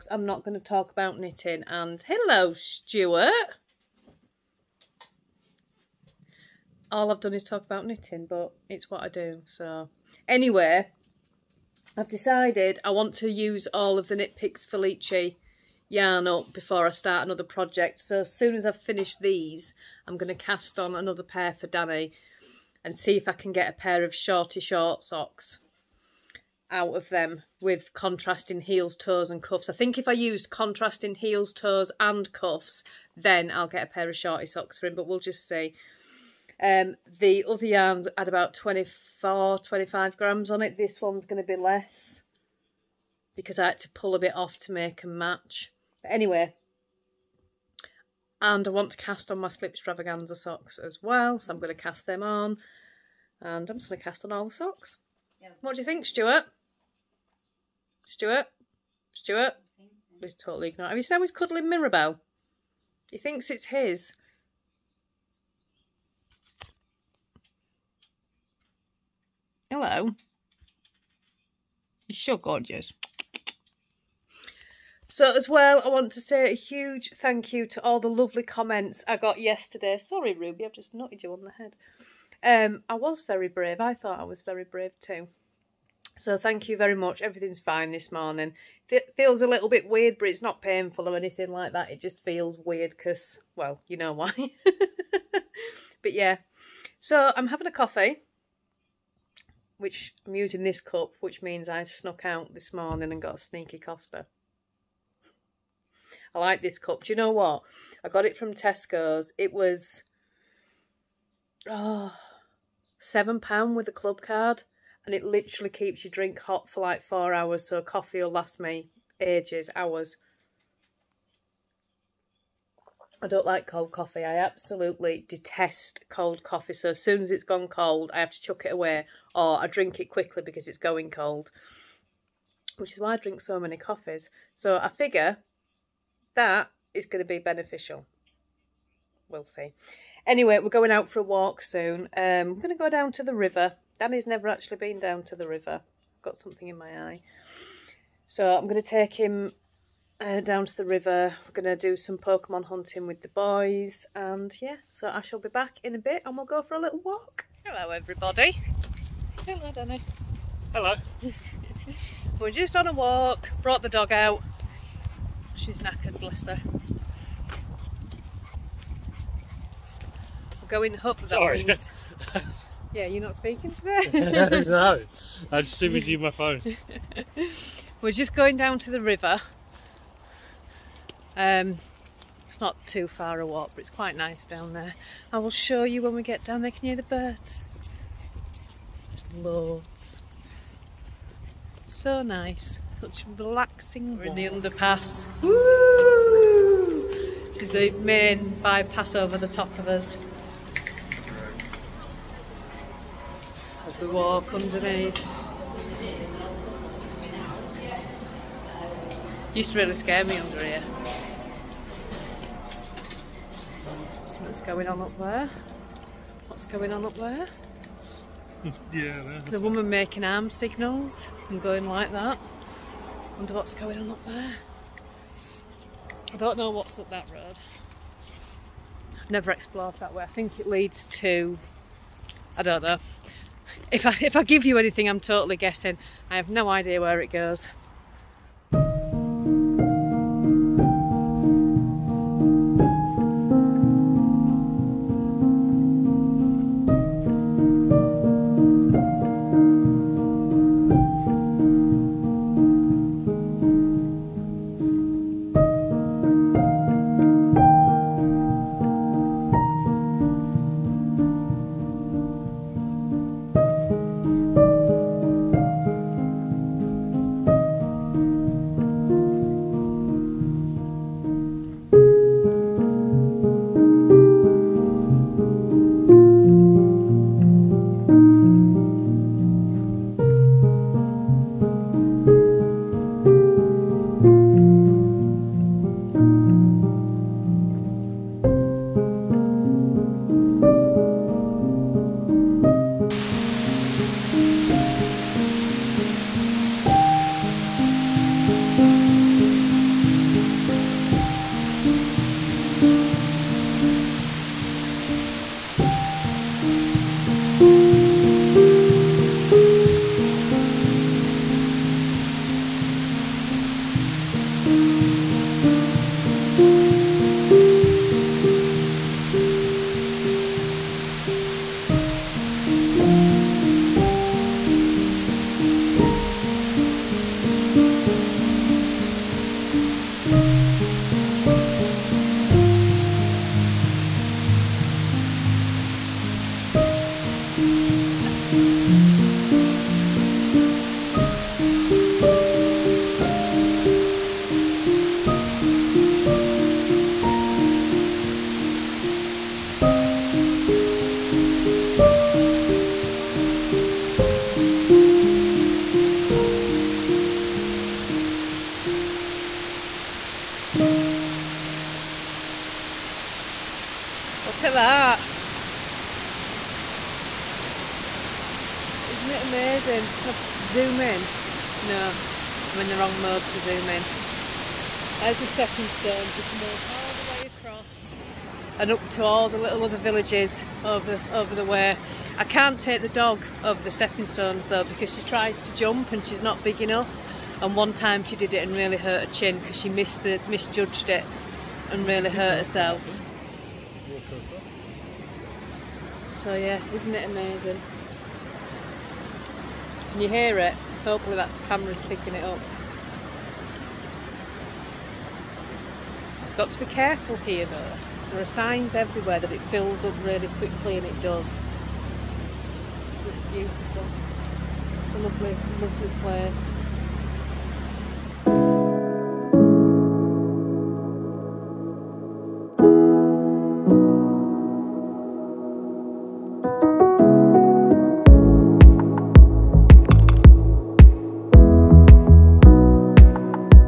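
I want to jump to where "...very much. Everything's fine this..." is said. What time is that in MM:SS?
01:26.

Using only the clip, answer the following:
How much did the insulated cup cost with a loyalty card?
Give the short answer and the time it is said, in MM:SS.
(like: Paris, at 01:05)
7 pounds, at 01:52.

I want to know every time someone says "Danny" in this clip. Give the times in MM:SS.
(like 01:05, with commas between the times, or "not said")
00:21, 02:23, 02:39.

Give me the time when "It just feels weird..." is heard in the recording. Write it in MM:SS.
01:31.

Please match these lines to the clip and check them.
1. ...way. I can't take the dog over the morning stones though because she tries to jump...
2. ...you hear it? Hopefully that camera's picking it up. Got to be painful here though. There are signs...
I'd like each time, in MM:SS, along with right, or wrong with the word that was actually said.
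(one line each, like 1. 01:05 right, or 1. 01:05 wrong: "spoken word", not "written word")
1. 06:21 wrong: "stepping", not "morning"
2. 06:40 wrong: "careful", not "painful".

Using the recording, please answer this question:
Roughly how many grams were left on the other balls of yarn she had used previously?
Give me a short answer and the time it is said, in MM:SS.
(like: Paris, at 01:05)
24, 25 grams, at 00:38.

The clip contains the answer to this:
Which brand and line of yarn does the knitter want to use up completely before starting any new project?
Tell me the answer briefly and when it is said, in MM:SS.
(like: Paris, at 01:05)
Knit Picks Felici, at 00:14.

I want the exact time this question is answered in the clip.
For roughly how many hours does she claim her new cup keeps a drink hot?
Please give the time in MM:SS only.
01:57.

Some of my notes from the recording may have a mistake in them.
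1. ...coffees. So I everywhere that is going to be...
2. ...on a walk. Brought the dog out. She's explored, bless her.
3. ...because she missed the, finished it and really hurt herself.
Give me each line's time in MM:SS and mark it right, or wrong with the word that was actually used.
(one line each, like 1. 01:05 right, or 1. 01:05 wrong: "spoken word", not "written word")
1. 02:13 wrong: "figure", not "everywhere"
2. 02:42 wrong: "knackered", not "explored"
3. 06:29 wrong: "misjudged", not "finished".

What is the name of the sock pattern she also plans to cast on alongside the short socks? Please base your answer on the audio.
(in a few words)
slip extravaganza.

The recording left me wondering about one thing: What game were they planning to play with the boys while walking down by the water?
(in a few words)
Pokemon.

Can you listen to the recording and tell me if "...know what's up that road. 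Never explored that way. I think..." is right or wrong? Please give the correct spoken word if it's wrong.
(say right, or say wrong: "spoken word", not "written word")
right.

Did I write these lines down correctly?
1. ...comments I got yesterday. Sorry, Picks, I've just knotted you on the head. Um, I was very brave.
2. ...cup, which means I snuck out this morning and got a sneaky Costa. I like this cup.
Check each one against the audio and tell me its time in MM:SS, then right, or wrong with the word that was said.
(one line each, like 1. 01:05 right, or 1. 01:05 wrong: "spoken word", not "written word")
1. 01:18 wrong: "Ruby", not "Picks"
2. 01:40 right.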